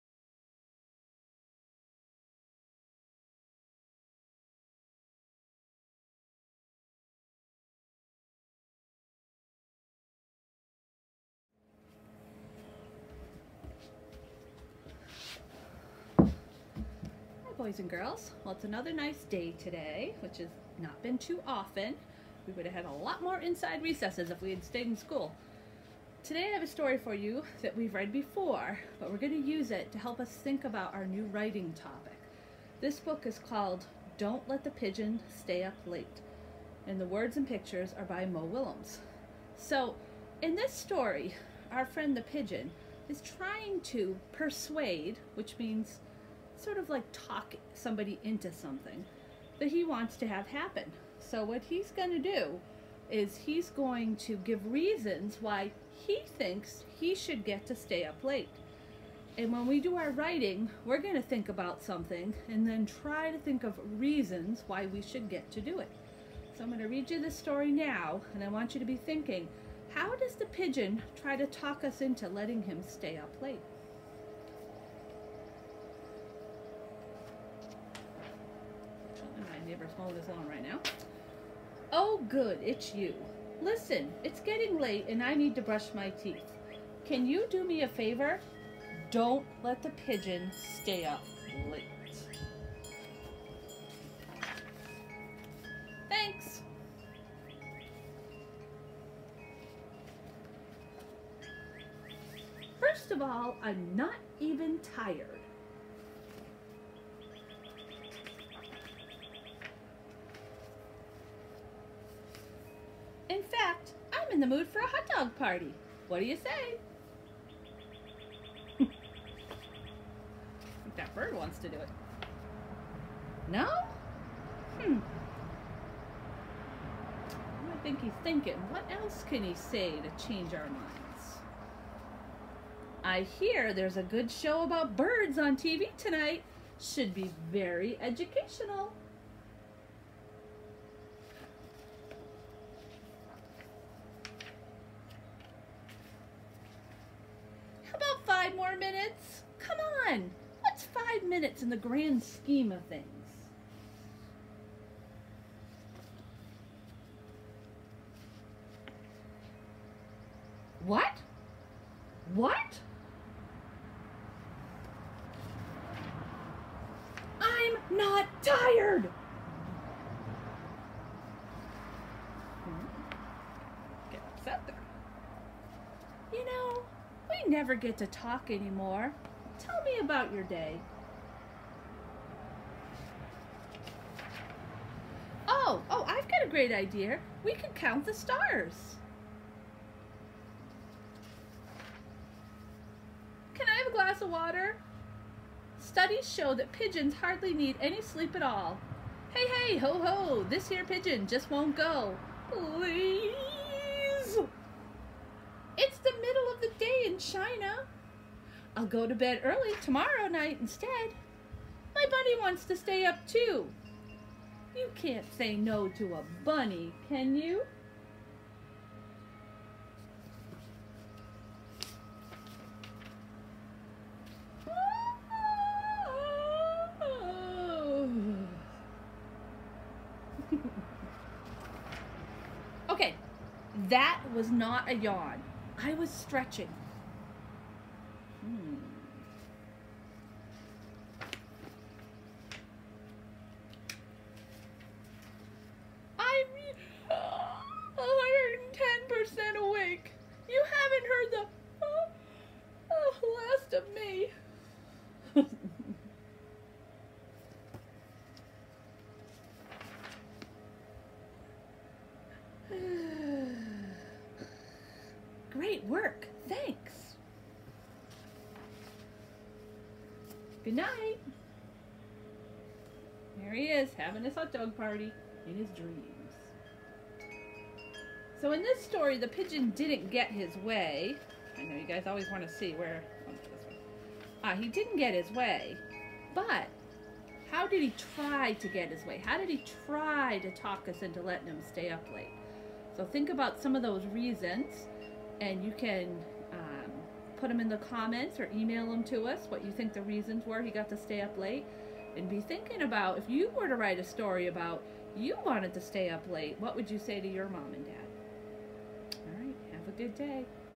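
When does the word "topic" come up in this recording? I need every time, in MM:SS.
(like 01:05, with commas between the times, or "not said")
00:31.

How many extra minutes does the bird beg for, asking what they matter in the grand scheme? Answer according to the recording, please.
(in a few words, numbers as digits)
5.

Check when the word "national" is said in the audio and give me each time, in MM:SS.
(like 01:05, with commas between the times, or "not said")
not said.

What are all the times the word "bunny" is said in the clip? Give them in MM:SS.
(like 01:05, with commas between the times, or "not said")
03:32, 03:36.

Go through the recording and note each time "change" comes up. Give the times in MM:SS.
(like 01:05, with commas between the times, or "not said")
02:10.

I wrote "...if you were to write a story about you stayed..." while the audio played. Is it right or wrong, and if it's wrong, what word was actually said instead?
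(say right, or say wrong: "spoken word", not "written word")
wrong: "wanted", not "stayed".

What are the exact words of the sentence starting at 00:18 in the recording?
Well, it's another nice day today, which has not been too often.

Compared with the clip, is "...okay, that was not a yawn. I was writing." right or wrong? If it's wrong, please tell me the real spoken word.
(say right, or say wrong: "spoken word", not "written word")
wrong: "stretching", not "writing".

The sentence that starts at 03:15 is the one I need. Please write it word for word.
Studies show that pigeons hardly need any sleep at all.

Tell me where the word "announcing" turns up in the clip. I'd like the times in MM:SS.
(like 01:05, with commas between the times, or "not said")
not said.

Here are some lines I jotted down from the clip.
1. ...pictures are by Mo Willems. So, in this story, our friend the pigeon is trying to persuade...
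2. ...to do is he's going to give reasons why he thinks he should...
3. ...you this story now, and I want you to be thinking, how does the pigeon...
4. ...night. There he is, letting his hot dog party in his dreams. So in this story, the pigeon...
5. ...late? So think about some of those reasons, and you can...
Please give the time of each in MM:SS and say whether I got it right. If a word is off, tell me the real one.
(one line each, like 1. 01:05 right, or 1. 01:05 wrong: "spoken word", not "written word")
1. 00:37 right
2. 00:52 right
3. 01:07 right
4. 04:30 wrong: "having", not "letting"
5. 04:52 right.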